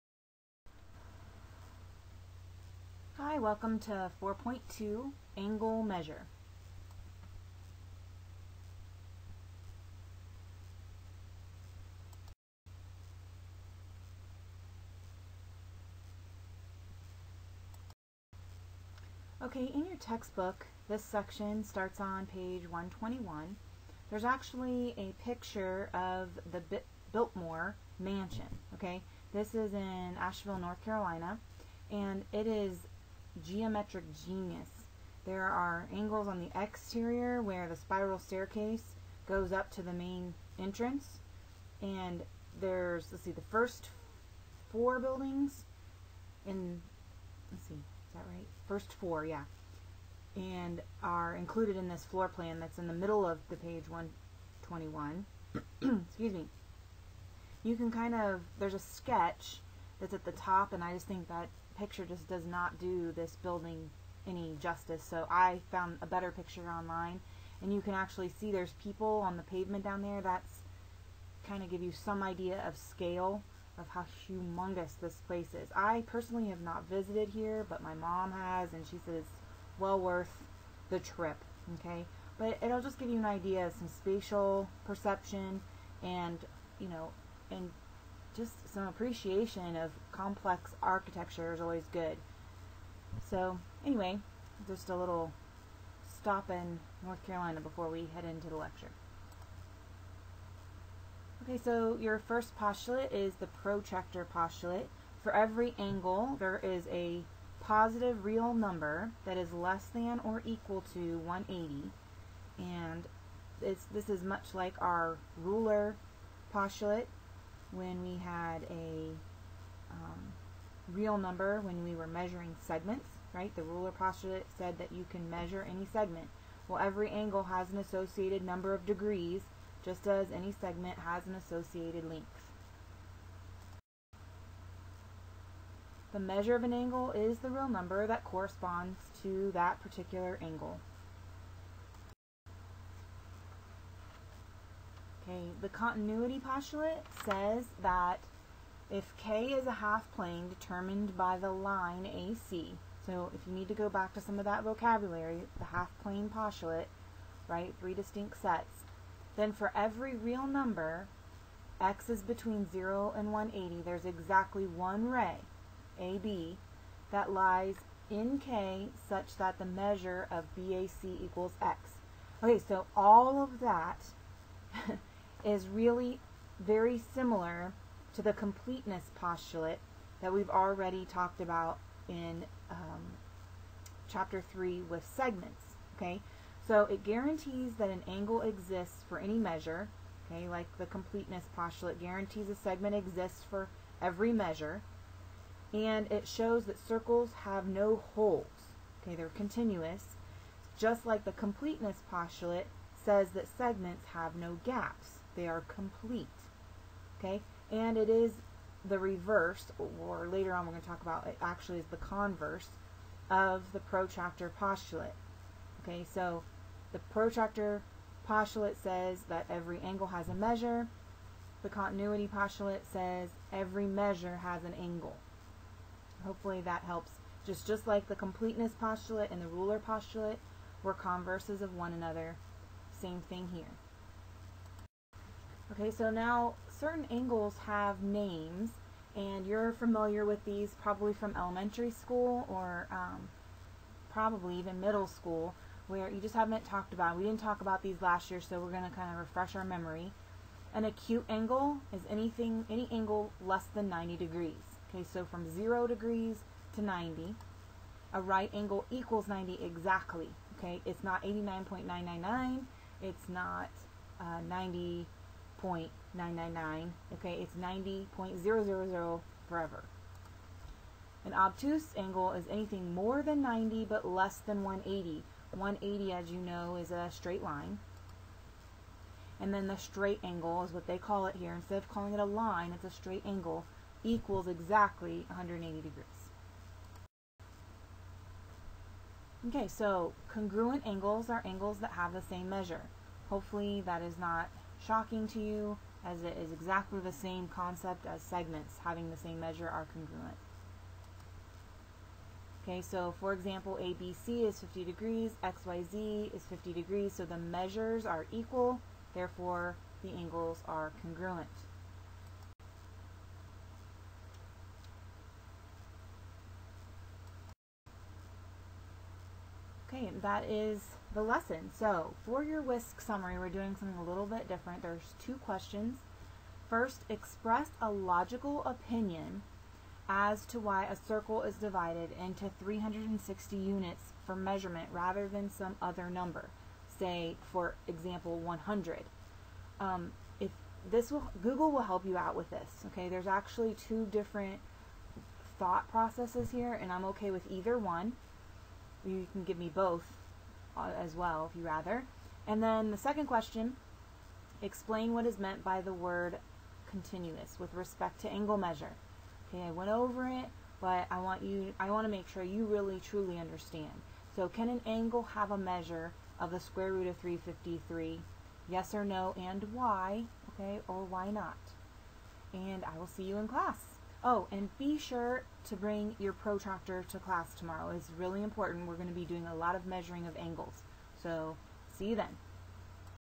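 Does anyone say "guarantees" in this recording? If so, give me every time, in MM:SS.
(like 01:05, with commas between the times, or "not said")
03:07, 03:11.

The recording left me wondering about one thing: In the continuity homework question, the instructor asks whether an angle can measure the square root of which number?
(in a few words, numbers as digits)
353.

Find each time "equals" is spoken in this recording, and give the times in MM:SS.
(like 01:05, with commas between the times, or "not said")
01:50, 02:51, 04:18, 04:44, 05:08.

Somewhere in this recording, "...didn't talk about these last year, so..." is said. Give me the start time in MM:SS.
04:07.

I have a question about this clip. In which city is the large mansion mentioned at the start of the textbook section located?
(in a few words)
Asheville, North Carolina.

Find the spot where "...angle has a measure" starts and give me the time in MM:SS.
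03:39.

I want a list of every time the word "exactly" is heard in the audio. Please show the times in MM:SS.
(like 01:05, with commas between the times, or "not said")
02:44, 04:19, 04:44, 04:56.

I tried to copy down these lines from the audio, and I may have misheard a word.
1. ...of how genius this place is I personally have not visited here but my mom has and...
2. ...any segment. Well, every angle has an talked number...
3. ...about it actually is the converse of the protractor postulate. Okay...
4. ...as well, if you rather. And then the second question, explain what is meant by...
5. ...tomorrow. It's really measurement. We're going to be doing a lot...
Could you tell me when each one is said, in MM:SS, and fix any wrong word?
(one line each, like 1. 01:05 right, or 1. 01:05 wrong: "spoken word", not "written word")
1. 01:13 wrong: "humongous", not "genius"
2. 02:05 wrong: "associated", not "talked"
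3. 03:31 right
4. 05:51 right
5. 06:17 wrong: "important", not "measurement".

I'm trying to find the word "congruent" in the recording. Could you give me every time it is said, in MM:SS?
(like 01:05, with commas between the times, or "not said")
04:50, 04:59, 05:11.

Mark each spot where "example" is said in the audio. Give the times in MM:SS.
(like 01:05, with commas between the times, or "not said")
05:03, 05:37.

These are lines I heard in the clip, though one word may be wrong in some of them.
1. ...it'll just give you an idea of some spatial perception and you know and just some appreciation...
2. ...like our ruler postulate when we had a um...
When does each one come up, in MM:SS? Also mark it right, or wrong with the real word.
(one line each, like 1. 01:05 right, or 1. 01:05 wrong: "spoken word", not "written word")
1. 01:22 right
2. 01:54 right.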